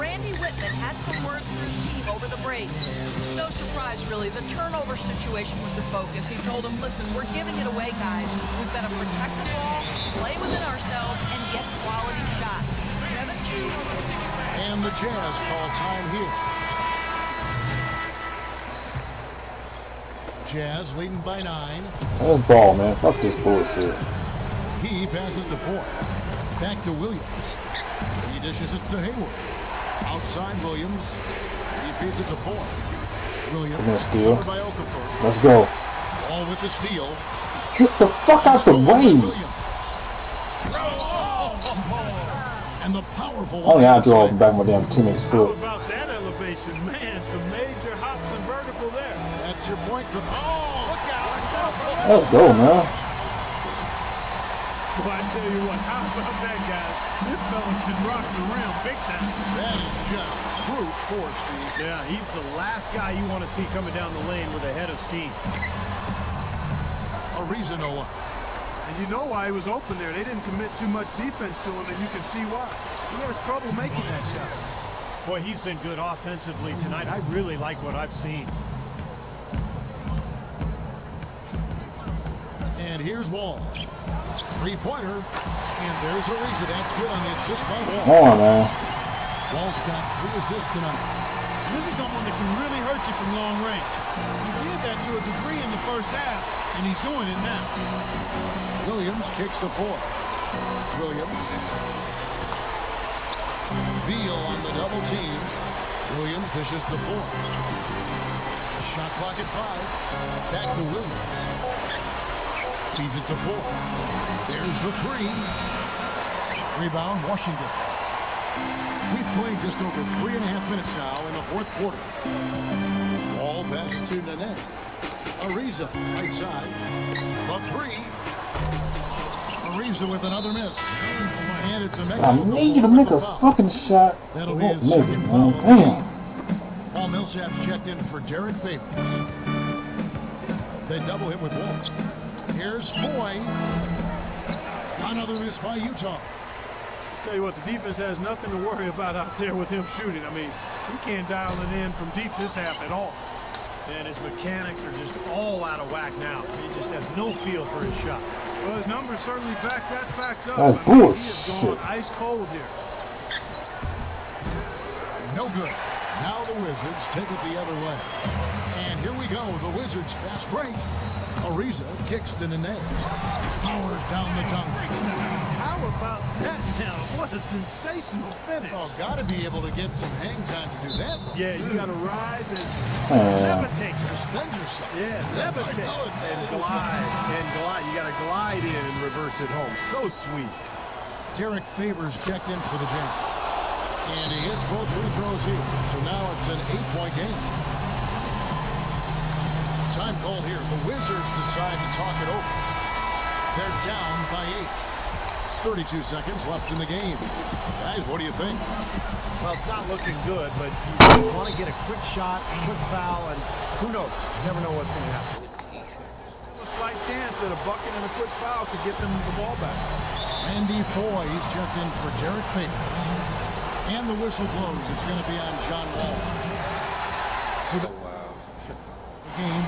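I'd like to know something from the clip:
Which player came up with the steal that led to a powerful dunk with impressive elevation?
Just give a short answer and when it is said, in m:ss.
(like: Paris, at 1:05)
Okafor, at 0:34.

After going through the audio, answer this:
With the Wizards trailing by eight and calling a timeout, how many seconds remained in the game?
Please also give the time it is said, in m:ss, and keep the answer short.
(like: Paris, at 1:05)
32, at 3:25.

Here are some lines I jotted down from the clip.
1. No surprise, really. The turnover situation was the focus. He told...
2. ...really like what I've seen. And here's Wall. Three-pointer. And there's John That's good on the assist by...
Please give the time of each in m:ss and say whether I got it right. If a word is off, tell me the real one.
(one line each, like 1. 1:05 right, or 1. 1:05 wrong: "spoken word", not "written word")
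1. 0:03 right
2. 1:17 wrong: "Ariza", not "John".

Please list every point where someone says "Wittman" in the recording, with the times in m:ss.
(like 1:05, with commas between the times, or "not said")
0:00.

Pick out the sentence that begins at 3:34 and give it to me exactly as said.
You never know what's going to happen.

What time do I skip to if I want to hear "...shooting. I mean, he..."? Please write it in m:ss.
2:29.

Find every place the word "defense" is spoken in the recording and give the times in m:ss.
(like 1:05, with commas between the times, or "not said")
1:11, 2:27.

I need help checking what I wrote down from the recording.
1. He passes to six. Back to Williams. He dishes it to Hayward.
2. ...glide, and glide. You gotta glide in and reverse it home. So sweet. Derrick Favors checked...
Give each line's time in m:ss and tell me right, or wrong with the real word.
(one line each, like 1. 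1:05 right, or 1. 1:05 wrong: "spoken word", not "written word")
1. 0:24 wrong: "four", not "six"
2. 3:06 right.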